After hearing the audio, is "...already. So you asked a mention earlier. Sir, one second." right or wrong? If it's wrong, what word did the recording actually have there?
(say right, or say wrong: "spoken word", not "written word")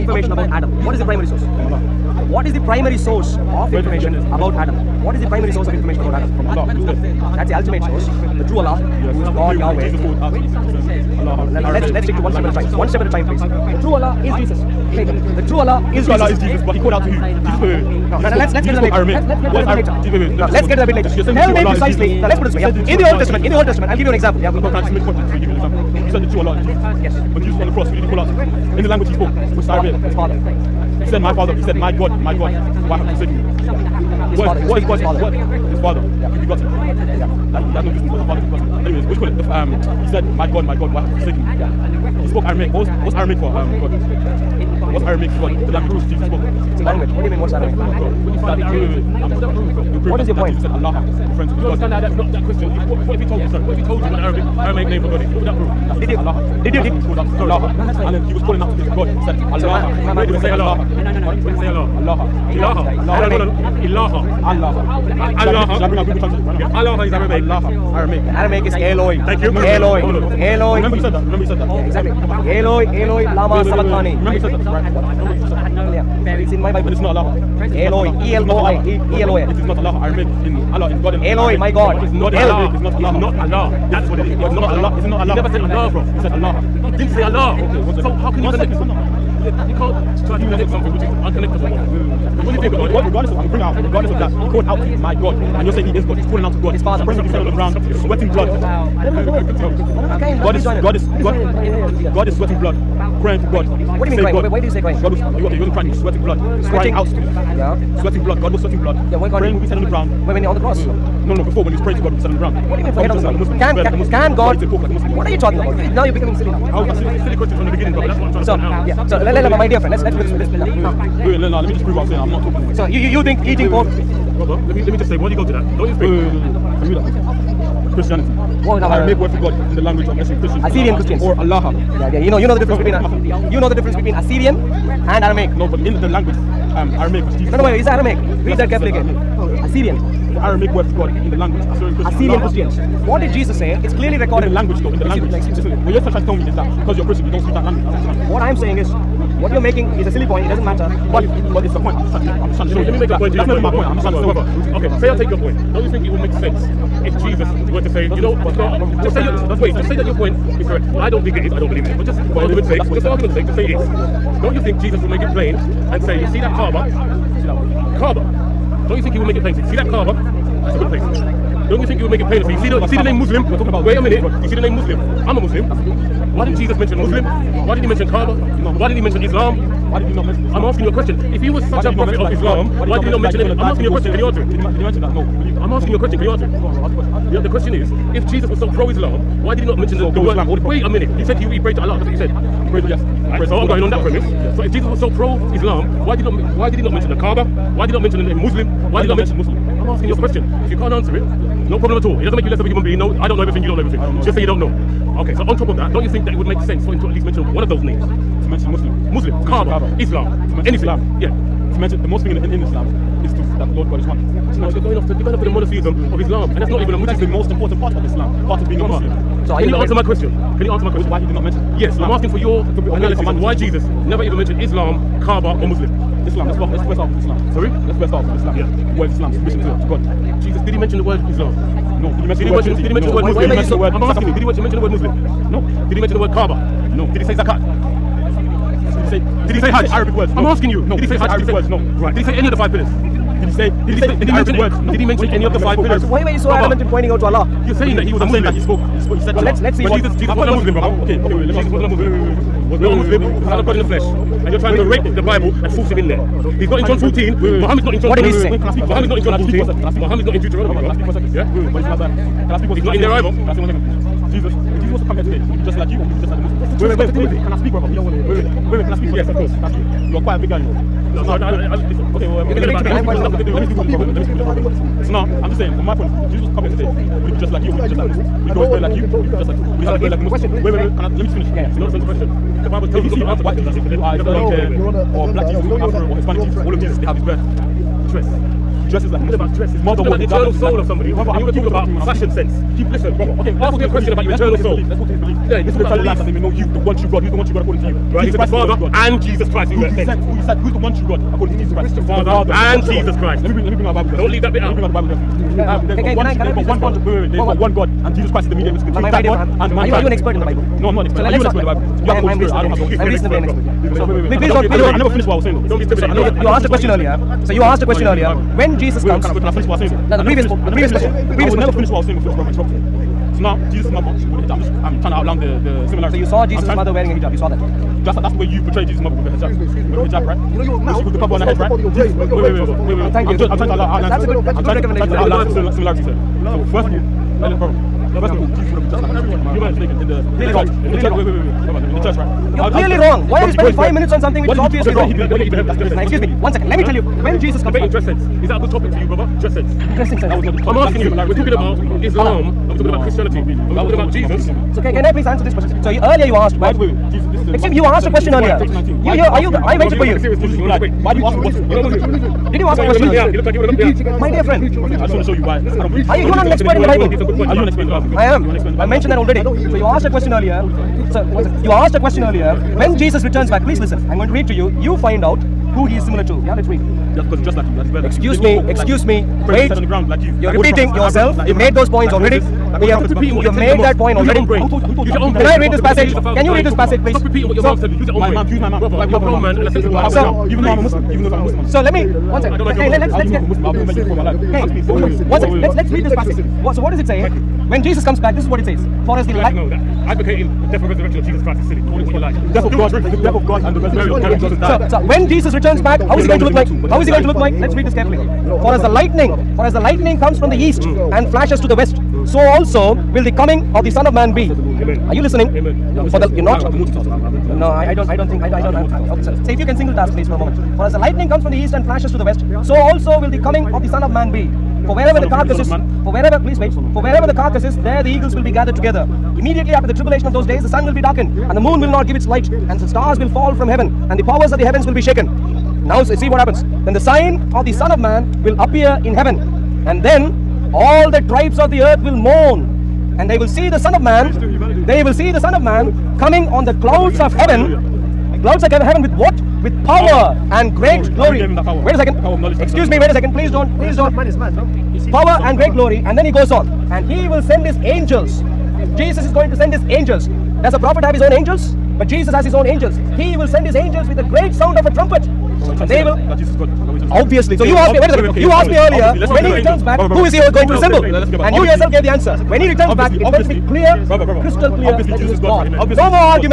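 wrong: "question", not "mention".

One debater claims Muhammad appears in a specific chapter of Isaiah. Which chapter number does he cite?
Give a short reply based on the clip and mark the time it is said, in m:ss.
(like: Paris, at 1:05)
Isaiah 42, at 4:21.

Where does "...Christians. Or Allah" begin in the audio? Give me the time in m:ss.
2:10.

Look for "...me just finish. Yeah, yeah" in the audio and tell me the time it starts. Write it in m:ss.
4:41.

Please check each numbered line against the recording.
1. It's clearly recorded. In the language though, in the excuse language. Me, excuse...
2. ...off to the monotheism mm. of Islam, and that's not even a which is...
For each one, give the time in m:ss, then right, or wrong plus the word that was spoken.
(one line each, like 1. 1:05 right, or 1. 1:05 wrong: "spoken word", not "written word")
1. 2:23 right
2. 3:35 right.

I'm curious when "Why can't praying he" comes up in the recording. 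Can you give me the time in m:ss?
1:49.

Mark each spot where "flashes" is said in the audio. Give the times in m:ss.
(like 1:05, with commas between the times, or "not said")
6:51, 7:01.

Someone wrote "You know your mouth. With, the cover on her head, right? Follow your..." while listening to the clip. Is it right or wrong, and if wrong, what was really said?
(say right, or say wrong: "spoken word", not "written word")
right.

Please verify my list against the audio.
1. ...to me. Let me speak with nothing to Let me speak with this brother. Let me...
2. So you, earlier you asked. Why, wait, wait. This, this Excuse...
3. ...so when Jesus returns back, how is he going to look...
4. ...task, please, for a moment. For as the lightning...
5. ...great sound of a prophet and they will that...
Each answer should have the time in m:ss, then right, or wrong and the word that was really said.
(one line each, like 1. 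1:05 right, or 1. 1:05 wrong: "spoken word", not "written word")
1. 4:32 right
2. 5:55 right
3. 6:45 right
4. 6:59 right
5. 7:44 wrong: "trumpet", not "prophet".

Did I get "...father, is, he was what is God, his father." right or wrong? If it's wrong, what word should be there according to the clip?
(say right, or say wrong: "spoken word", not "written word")
right.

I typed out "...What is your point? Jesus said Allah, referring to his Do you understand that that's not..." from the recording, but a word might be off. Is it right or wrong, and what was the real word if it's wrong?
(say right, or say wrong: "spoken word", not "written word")
right.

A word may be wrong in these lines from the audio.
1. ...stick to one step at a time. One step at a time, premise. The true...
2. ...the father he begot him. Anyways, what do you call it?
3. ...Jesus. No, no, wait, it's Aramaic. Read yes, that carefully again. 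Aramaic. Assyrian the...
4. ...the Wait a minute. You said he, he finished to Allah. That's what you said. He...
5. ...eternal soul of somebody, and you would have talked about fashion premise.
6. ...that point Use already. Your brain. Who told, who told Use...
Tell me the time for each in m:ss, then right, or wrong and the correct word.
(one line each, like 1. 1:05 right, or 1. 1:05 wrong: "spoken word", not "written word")
1. 0:12 wrong: "please", not "premise"
2. 0:38 right
3. 2:17 right
4. 3:10 wrong: "prayed", not "finished"
5. 4:50 wrong: "sense", not "premise"
6. 6:23 right.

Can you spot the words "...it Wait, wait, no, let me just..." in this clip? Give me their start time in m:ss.
2:00.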